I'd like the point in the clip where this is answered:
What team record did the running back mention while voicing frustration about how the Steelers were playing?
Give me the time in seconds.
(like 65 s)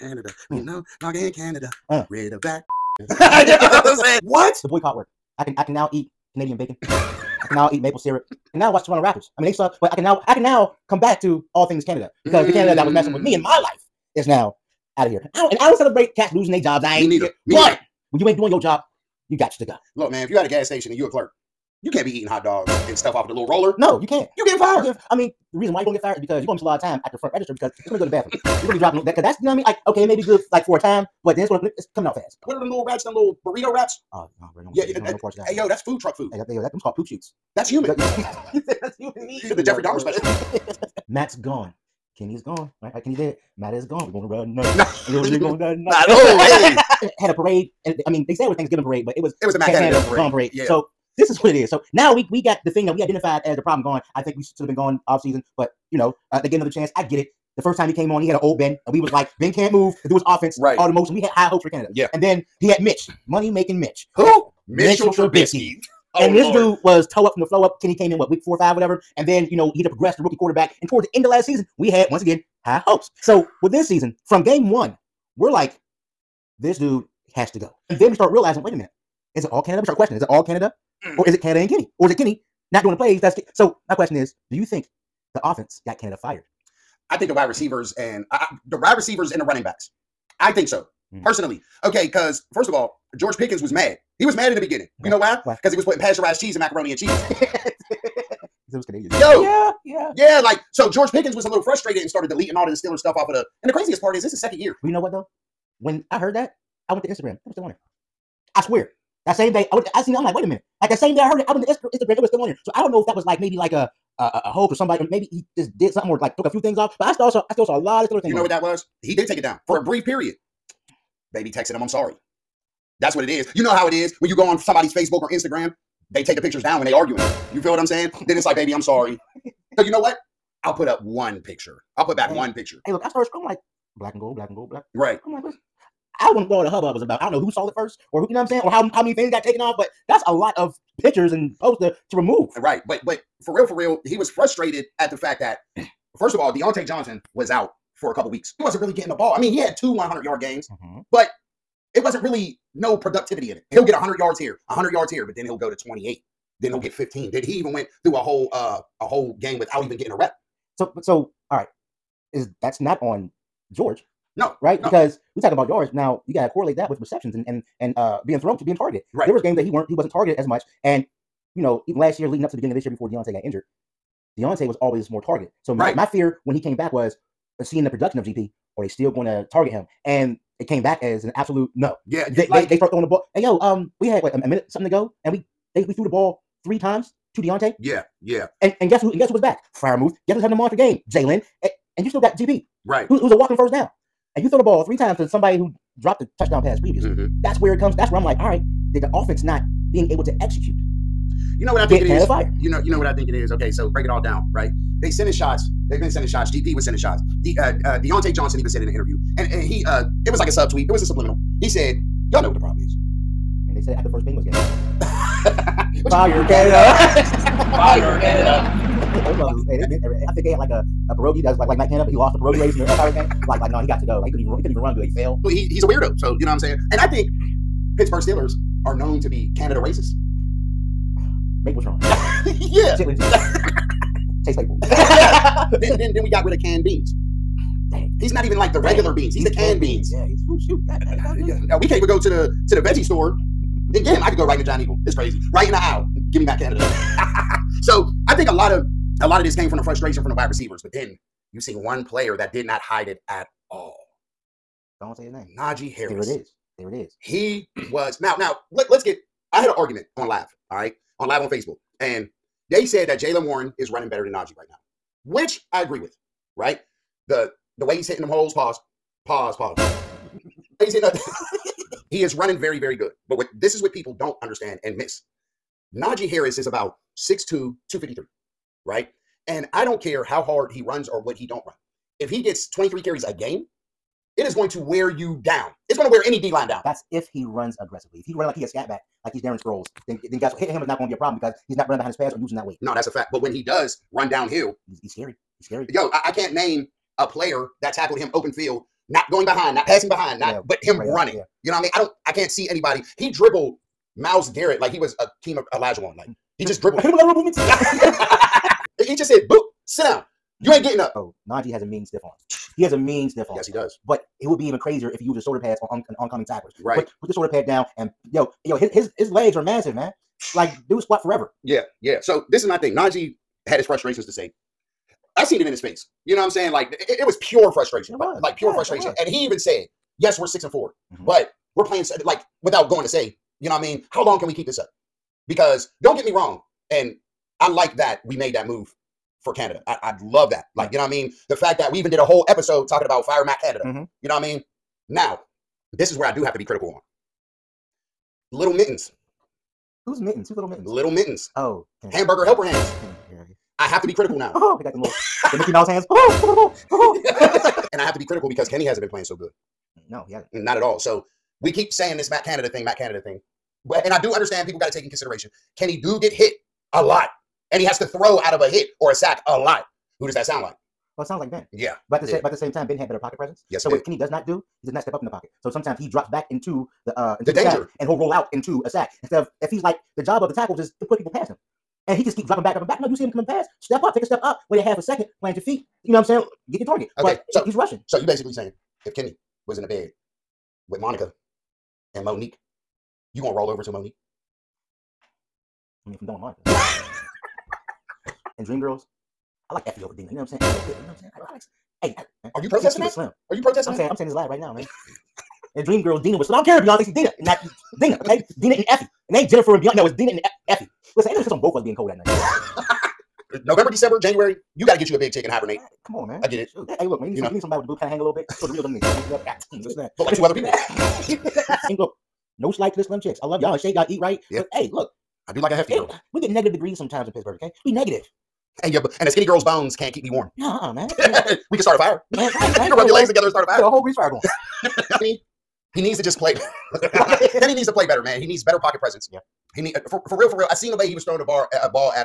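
330 s.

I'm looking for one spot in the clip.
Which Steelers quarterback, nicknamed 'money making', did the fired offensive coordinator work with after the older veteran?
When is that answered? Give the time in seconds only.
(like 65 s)
65 s.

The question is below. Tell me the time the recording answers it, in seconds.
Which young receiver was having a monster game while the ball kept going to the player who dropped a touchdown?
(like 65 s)
191 s.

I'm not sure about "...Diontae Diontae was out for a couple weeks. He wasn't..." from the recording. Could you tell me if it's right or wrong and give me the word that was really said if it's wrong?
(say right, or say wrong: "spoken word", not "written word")
wrong: "Johnson", not "Diontae".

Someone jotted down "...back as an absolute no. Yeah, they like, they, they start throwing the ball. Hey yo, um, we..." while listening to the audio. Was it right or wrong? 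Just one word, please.
right.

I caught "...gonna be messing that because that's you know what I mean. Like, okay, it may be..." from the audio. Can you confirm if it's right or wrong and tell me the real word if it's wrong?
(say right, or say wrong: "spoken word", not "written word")
wrong: "dropping", not "messing".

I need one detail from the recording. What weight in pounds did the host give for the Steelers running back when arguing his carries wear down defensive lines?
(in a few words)
253.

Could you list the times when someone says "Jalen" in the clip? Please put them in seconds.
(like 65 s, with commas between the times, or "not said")
263 s.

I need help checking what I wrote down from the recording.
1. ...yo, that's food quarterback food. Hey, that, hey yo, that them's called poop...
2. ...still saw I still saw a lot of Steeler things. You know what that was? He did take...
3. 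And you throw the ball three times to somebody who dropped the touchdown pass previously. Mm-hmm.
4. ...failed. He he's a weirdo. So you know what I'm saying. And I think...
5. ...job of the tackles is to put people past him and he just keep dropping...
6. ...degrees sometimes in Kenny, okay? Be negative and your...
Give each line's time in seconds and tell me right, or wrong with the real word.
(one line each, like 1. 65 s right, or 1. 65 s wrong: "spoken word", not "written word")
1. 35 s wrong: "truck", not "quarterback"
2. 117 s right
3. 194 s right
4. 225 s right
5. 380 s right
6. 426 s wrong: "Pittsburgh", not "Kenny".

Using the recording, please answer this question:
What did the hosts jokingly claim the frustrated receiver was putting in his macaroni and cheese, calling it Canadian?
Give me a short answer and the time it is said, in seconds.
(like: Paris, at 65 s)
Pasteurized cheese, at 95 s.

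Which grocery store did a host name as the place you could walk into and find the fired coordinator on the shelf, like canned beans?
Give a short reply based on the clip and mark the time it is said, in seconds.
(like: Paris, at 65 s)
Giant Eagle, at 244 s.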